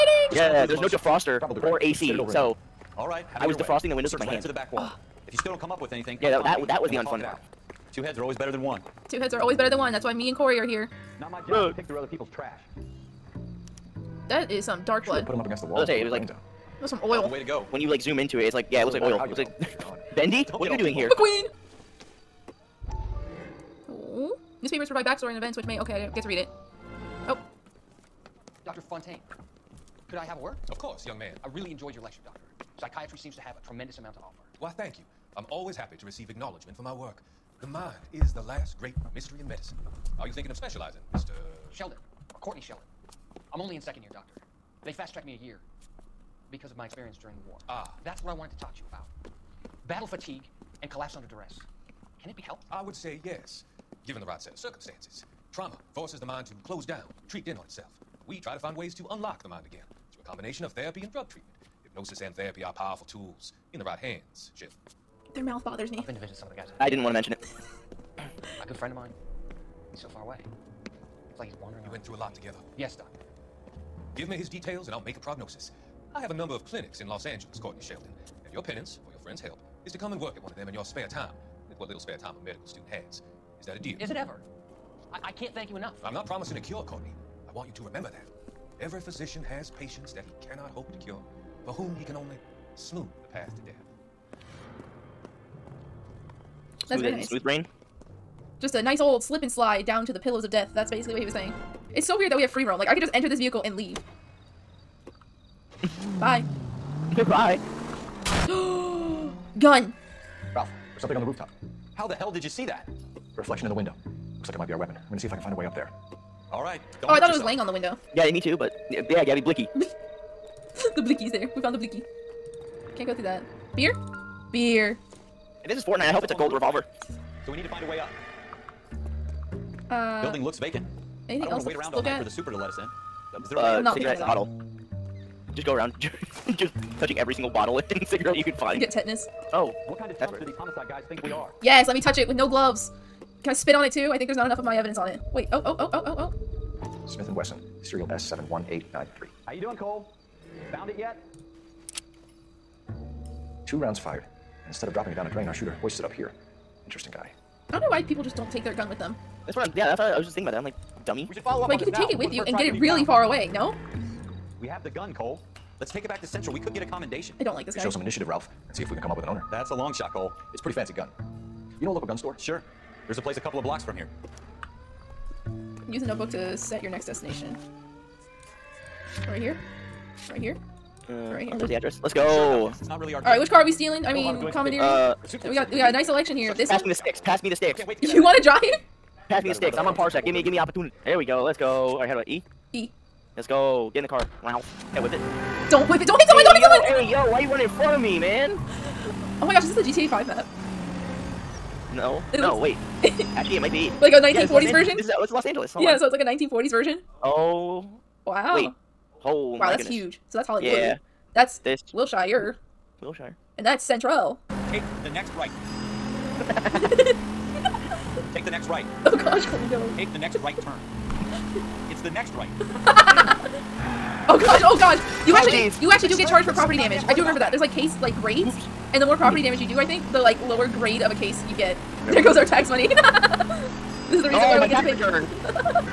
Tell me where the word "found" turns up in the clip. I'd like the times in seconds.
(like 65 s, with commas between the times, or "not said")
121 s, 150 s.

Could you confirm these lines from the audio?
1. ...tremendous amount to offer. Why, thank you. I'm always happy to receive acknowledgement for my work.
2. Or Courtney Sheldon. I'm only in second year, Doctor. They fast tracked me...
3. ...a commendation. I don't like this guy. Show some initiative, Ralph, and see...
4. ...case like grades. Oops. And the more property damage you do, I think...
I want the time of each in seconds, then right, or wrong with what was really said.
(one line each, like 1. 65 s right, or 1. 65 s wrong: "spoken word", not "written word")
1. 33 s right
2. 42 s right
3. 166 s right
4. 227 s right.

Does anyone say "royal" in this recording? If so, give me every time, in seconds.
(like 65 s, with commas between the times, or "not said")
not said.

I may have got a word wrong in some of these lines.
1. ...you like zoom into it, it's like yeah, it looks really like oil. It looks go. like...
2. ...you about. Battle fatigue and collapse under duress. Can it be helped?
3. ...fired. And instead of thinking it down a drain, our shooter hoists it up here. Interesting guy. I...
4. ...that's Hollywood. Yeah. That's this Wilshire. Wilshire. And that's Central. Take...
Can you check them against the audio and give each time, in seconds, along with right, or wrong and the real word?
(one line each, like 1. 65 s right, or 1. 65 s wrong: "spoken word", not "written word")
1. 17 s right
2. 48 s right
3. 153 s wrong: "dropping", not "thinking"
4. 210 s right.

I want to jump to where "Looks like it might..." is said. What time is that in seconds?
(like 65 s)
114 s.